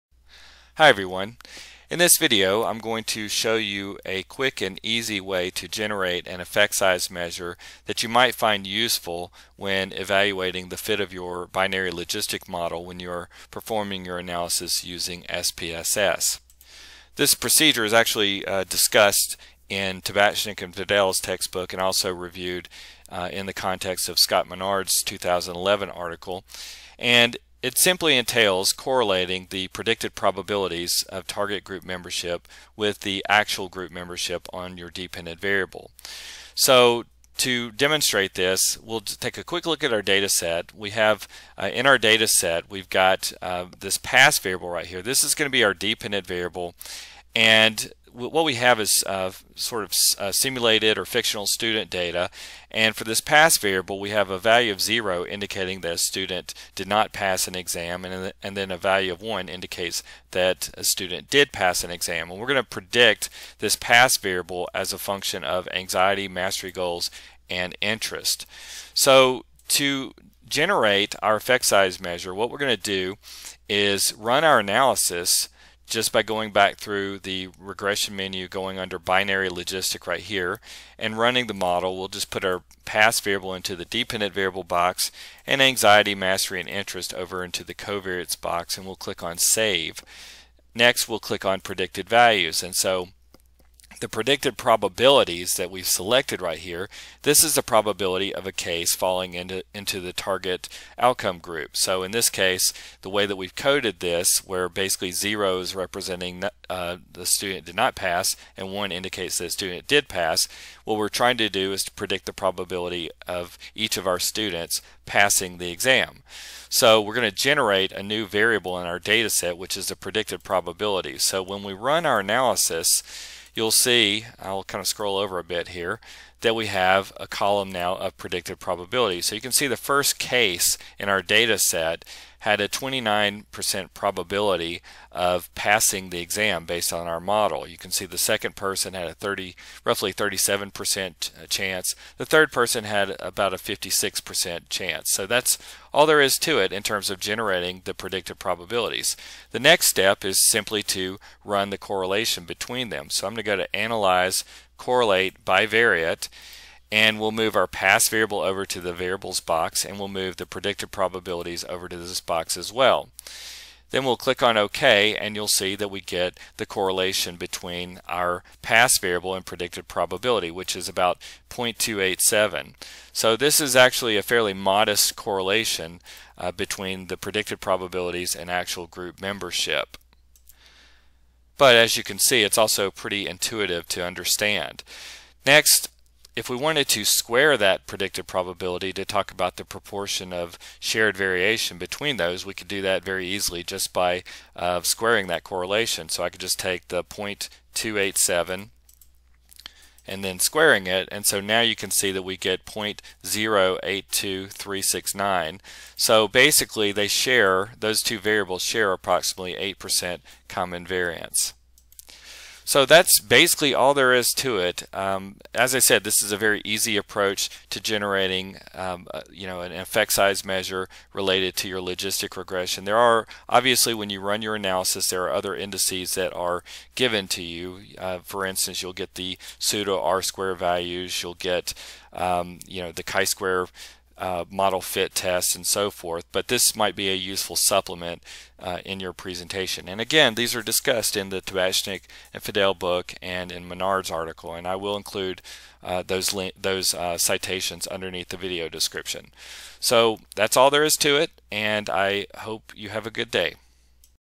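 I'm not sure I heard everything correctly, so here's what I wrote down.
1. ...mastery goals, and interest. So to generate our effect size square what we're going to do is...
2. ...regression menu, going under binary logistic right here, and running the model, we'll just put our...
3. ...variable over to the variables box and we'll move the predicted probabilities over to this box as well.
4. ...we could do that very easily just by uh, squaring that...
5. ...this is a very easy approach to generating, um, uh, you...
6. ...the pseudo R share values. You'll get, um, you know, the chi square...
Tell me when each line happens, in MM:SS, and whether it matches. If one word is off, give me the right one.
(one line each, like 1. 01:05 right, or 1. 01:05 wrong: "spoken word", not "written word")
1. 01:06 wrong: "measure", not "square"
2. 01:17 right
3. 02:38 right
4. 03:12 right
5. 03:36 right
6. 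03:49 wrong: "square", not "share".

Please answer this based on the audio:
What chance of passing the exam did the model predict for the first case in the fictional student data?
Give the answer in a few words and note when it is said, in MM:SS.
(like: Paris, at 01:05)
29%, at 02:12.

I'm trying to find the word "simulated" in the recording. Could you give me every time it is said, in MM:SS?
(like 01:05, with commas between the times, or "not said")
00:50.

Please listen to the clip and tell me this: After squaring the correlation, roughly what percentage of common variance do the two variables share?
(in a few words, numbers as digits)
8%.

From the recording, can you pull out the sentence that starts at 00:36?
So to demonstrate this, we'll take a quick look at our data set.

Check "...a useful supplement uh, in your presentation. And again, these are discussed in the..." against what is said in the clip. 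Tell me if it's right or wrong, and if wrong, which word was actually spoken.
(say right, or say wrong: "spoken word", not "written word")
right.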